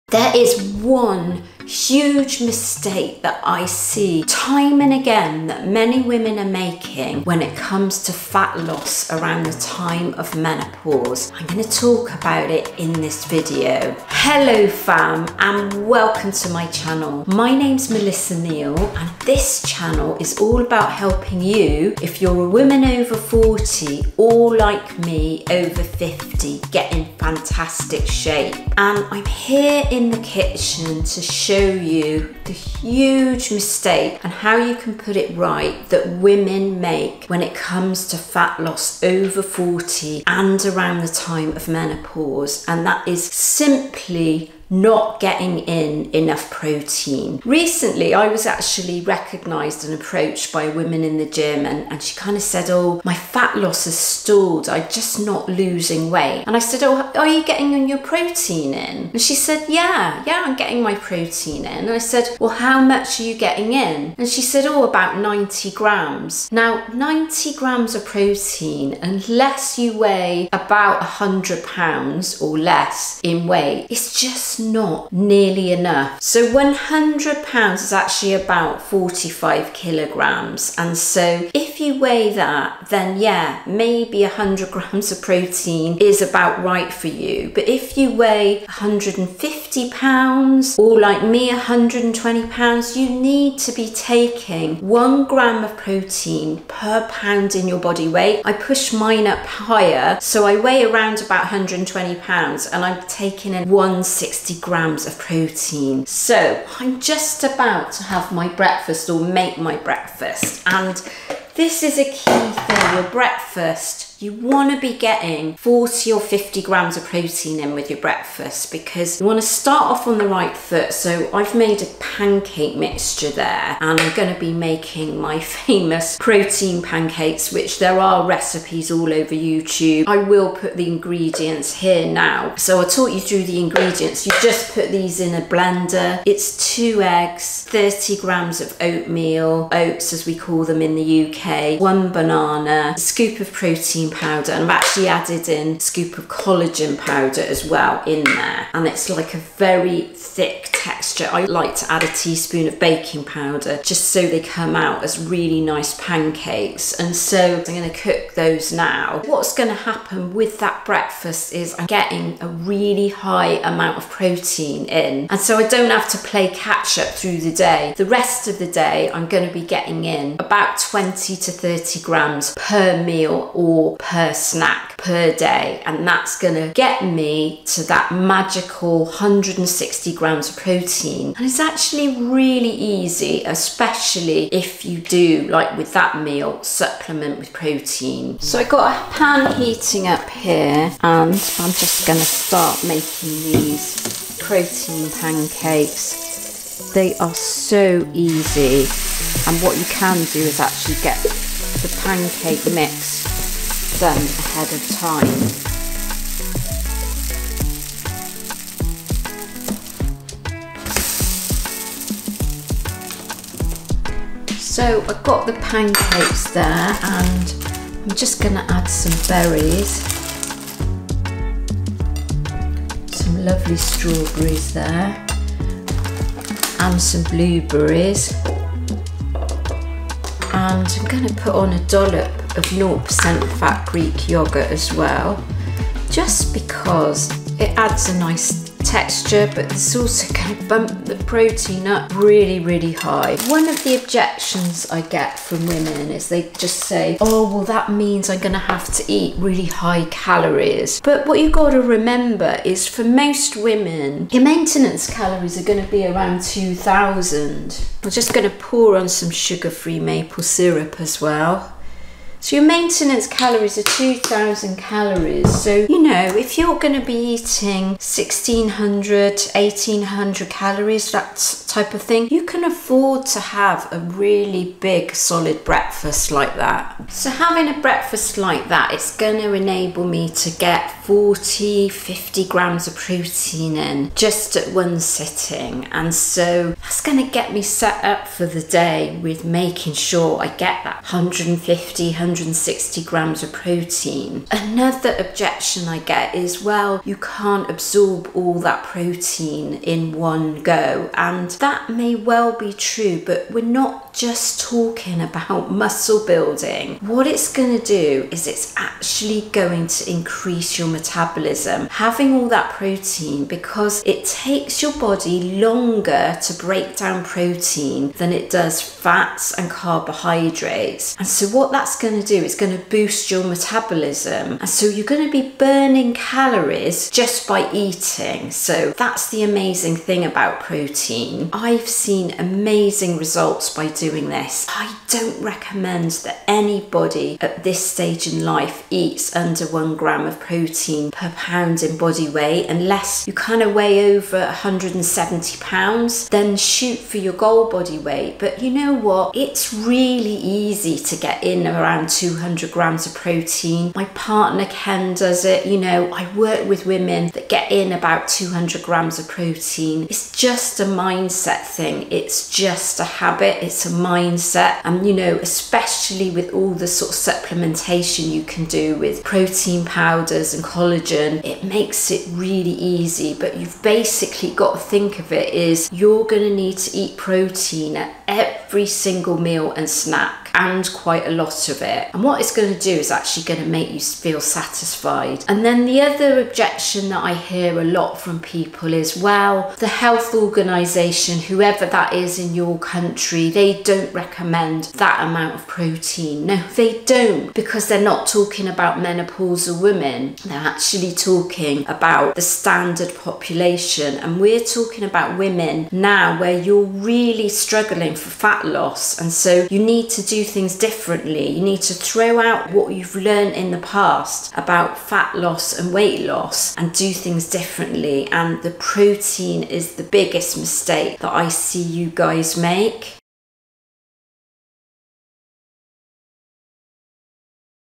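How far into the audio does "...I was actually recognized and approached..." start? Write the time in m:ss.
0:48.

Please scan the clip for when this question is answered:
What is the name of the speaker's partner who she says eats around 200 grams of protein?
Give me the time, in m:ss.
5:54.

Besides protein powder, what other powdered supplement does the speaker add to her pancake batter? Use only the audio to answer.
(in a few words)
collagen powder.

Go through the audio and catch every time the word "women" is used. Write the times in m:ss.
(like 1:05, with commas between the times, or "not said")
0:06, 0:36, 4:05, 4:13, 5:56, 6:39, 6:45.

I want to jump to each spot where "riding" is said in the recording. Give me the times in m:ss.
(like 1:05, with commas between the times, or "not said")
not said.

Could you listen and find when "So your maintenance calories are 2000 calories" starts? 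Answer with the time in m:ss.
4:22.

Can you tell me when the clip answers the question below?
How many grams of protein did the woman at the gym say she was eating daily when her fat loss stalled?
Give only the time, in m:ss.
1:04.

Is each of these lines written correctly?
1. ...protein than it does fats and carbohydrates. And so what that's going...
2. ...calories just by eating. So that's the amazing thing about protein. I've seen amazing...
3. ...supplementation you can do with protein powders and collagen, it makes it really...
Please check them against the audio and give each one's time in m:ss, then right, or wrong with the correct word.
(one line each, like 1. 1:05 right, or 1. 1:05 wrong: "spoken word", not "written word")
1. 5:17 right
2. 5:26 right
3. 6:07 right.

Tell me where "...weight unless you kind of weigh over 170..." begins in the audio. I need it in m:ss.
5:42.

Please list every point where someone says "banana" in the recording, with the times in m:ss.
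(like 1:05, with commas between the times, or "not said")
2:22.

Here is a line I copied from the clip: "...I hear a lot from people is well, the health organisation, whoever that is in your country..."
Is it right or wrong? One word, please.
right.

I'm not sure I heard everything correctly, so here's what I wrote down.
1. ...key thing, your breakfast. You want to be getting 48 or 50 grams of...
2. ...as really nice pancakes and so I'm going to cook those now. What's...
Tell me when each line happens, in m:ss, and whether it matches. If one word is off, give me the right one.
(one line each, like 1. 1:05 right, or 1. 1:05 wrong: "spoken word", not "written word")
1. 1:52 wrong: "40", not "48"
2. 2:35 right.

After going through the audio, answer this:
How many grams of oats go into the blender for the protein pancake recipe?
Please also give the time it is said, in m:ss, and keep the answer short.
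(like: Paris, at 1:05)
30 grams, at 2:17.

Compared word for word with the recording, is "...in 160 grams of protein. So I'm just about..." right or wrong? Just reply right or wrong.
right.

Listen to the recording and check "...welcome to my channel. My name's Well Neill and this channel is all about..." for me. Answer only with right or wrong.
wrong.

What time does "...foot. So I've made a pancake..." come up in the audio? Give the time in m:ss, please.
2:00.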